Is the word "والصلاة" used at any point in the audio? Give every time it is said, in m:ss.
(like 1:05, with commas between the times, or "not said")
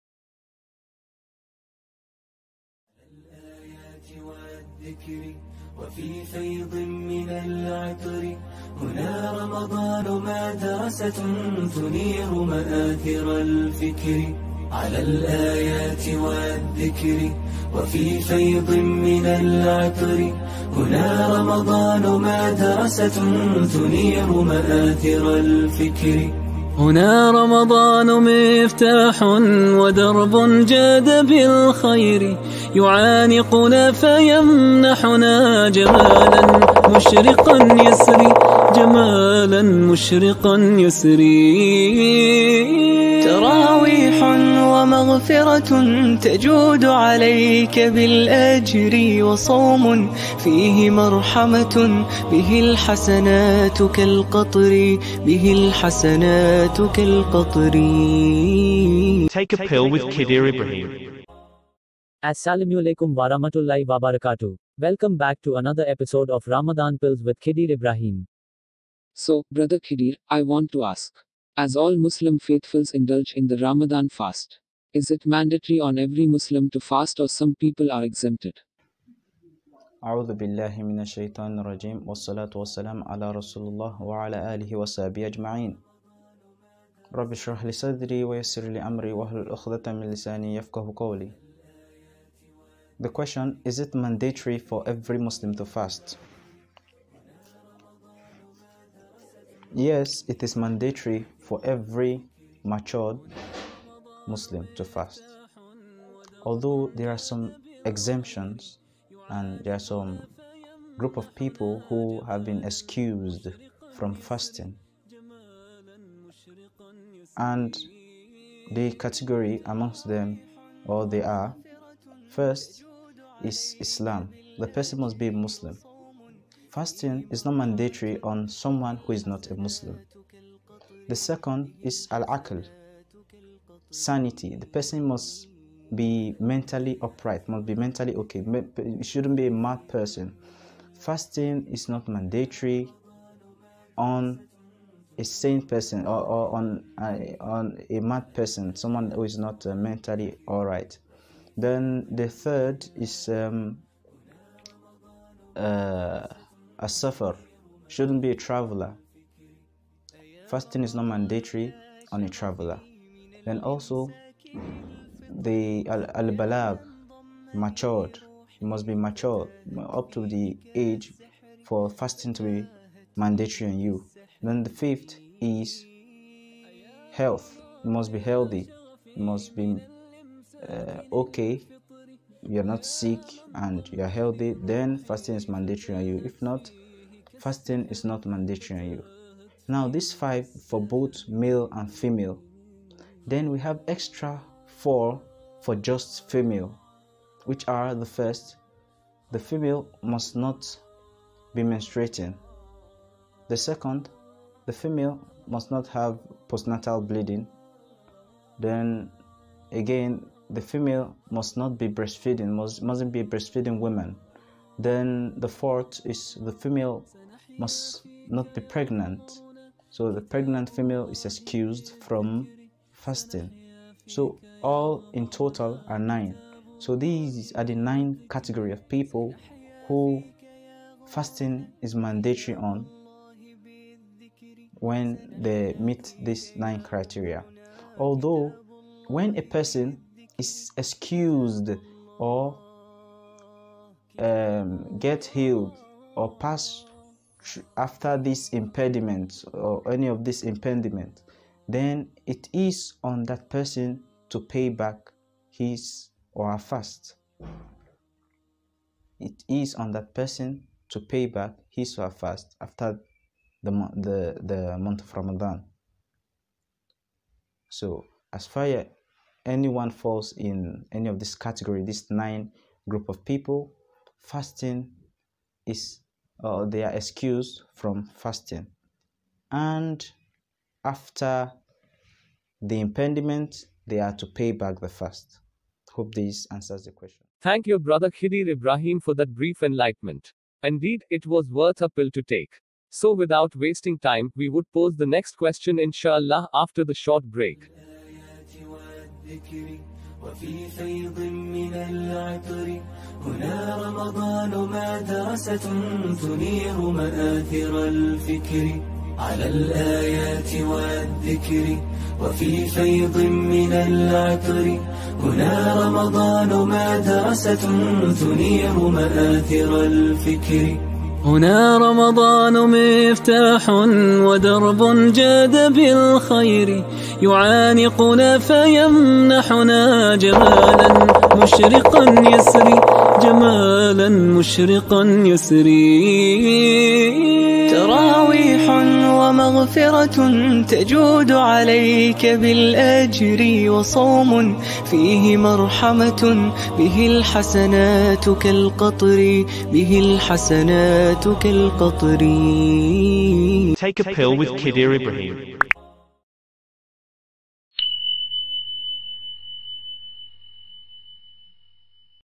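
1:22.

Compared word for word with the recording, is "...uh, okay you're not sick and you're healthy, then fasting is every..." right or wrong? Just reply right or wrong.
wrong.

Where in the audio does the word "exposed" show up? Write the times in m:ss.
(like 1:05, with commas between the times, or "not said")
not said.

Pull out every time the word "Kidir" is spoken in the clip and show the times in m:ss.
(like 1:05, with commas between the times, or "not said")
1:00, 5:54.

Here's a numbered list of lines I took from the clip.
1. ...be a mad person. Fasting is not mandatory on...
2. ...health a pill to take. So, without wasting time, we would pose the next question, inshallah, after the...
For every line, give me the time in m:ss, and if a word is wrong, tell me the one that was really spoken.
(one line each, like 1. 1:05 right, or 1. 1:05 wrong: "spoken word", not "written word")
1. 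2:19 right
2. 4:51 wrong: "worth", not "health".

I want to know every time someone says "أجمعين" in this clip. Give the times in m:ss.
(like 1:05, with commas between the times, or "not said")
1:25.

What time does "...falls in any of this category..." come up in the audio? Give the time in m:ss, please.
4:29.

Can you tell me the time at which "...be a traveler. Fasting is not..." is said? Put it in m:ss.
2:38.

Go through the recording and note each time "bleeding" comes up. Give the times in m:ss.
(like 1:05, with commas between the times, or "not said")
3:27.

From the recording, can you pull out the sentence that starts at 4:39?
And after the impediment, they are to pay back the fast.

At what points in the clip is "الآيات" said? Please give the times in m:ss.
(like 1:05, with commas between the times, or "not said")
0:15, 5:09.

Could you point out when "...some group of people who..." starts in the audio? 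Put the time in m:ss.
1:49.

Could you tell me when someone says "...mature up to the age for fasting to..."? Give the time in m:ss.
2:48.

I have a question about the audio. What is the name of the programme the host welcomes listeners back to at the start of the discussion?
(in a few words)
Ramadan Pills.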